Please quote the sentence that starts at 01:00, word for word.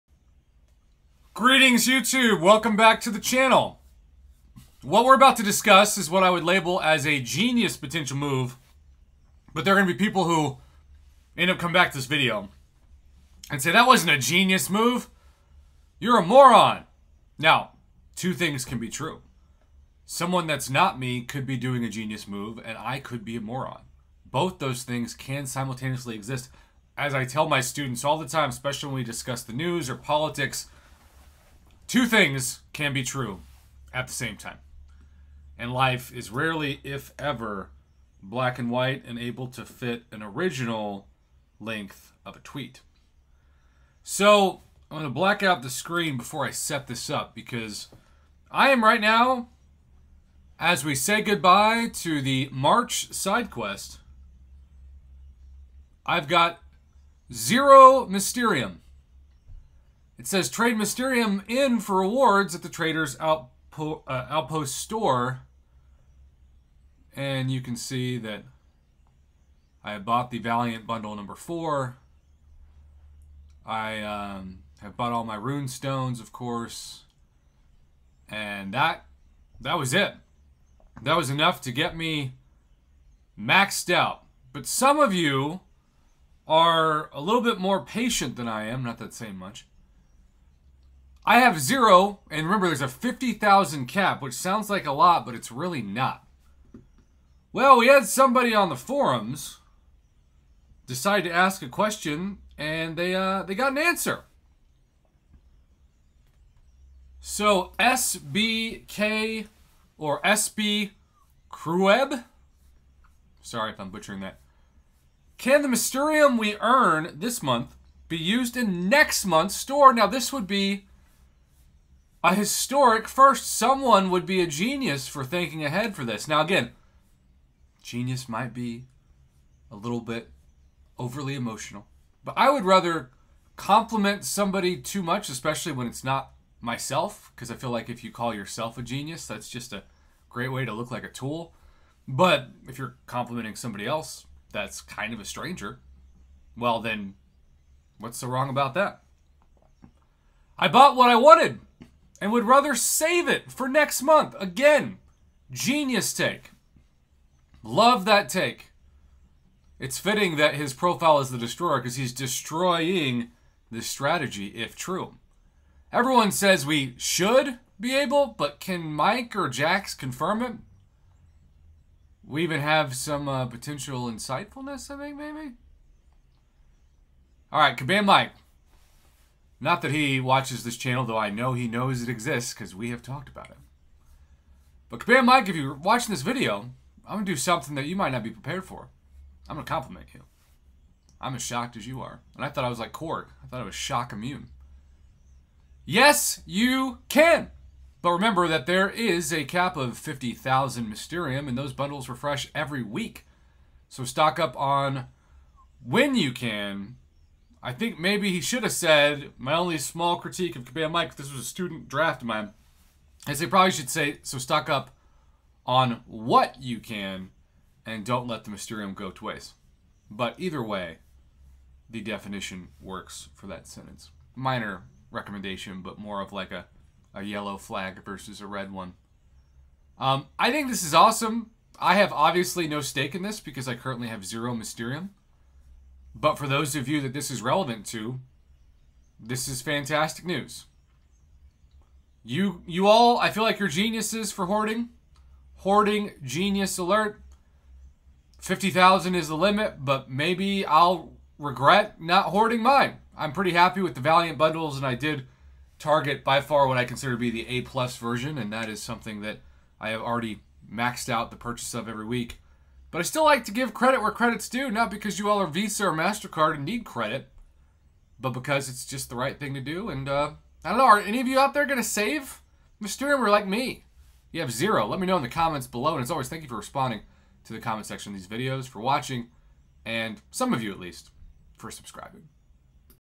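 It says trade Mysterium in for rewards at the trader's outpo uh, outpost store.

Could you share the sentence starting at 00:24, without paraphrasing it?
Both those things can simultaneously exist.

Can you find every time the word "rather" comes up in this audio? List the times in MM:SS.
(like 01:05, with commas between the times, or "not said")
02:12, 02:32.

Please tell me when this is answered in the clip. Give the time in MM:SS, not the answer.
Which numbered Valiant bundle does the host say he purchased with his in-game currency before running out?
01:10.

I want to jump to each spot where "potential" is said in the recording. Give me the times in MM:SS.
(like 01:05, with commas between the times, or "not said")
00:07, 02:53.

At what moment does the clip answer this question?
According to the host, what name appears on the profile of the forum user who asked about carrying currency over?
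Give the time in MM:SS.
02:41.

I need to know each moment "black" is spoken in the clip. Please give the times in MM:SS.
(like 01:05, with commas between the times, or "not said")
00:38, 00:45.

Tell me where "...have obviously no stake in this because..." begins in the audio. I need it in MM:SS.
03:51.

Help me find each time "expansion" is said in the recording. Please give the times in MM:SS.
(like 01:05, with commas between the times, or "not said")
not said.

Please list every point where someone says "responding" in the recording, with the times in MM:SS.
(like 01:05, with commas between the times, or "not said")
04:36.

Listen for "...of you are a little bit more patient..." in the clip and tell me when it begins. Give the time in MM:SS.
01:24.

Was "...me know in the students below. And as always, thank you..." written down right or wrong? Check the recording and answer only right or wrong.
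wrong.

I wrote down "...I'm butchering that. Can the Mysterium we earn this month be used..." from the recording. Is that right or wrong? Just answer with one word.
right.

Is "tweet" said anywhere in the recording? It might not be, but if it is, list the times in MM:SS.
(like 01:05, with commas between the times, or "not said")
00:42.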